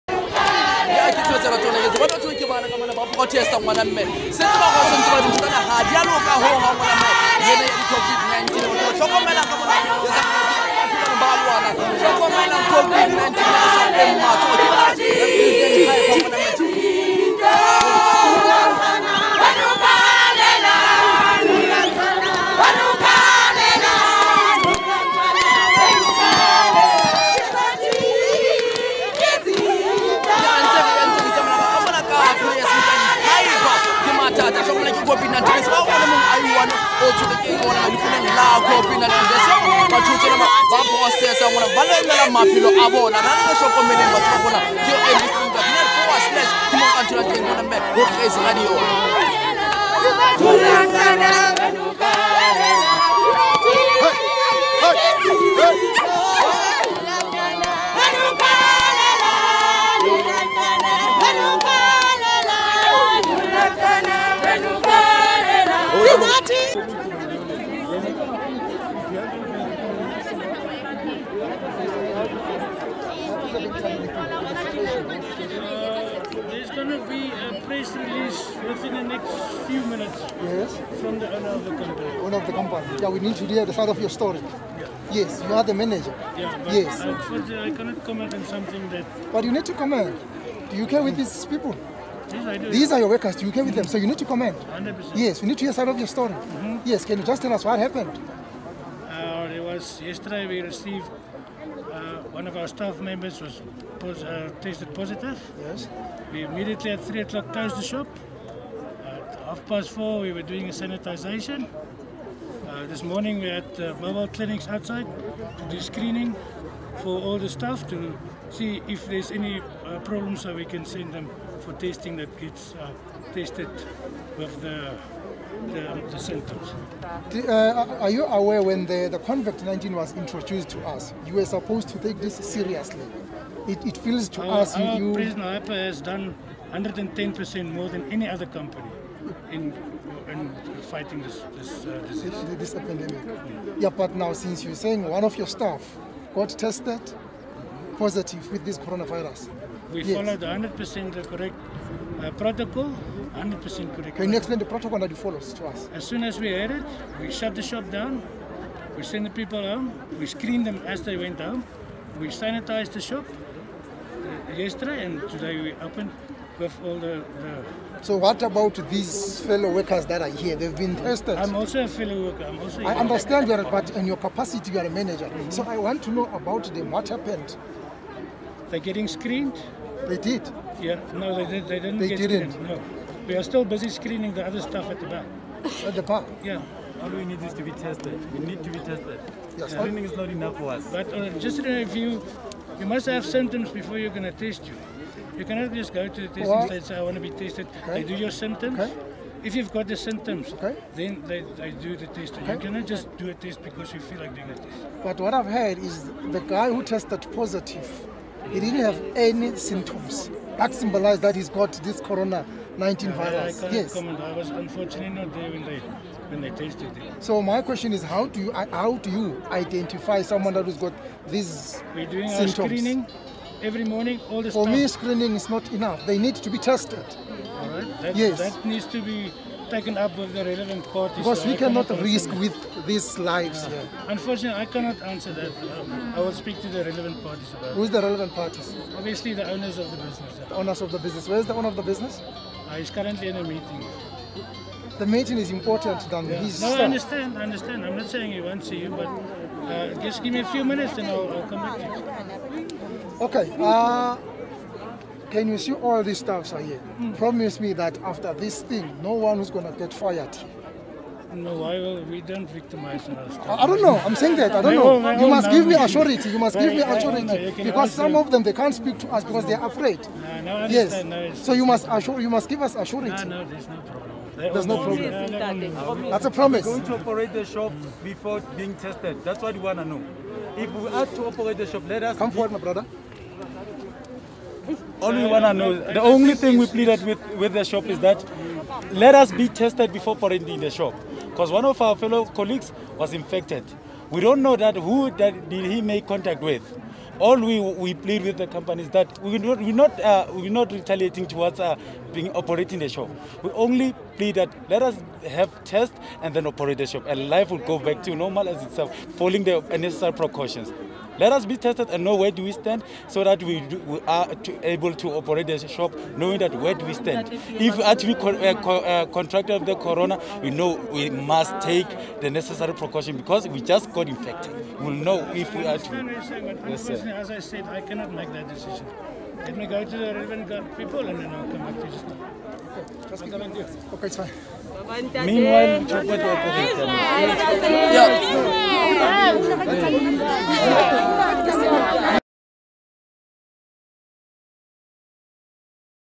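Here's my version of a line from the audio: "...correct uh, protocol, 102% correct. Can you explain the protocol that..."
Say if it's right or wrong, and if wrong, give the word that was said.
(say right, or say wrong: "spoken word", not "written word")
wrong: "100", not "102".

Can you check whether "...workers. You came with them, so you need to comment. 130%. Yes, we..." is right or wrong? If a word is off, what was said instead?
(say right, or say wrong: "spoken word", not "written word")
wrong: "100", not "130".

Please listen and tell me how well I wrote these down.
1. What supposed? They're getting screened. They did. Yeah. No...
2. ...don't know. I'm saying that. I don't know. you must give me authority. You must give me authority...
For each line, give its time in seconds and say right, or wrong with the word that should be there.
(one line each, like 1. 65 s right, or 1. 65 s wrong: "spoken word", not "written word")
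1. 176 s wrong: "happened", not "supposed"
2. 263 s right.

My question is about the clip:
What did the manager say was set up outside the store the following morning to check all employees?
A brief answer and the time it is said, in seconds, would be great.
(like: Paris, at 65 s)
Mobile clinics, at 114 s.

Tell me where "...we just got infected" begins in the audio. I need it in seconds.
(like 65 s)
323 s.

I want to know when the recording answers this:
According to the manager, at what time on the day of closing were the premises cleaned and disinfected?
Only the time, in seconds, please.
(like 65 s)
109 s.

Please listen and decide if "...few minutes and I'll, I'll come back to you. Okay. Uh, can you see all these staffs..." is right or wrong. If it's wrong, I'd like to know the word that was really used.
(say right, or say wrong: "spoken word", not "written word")
right.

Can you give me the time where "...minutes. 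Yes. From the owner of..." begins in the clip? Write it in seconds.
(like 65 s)
79 s.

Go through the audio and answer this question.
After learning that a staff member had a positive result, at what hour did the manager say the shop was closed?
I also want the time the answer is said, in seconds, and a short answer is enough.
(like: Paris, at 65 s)
3 o'clock, at 107 s.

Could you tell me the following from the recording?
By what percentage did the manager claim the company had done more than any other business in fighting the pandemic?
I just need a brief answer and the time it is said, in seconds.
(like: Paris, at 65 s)
110%, at 136 s.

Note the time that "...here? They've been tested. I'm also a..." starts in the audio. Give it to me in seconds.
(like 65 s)
170 s.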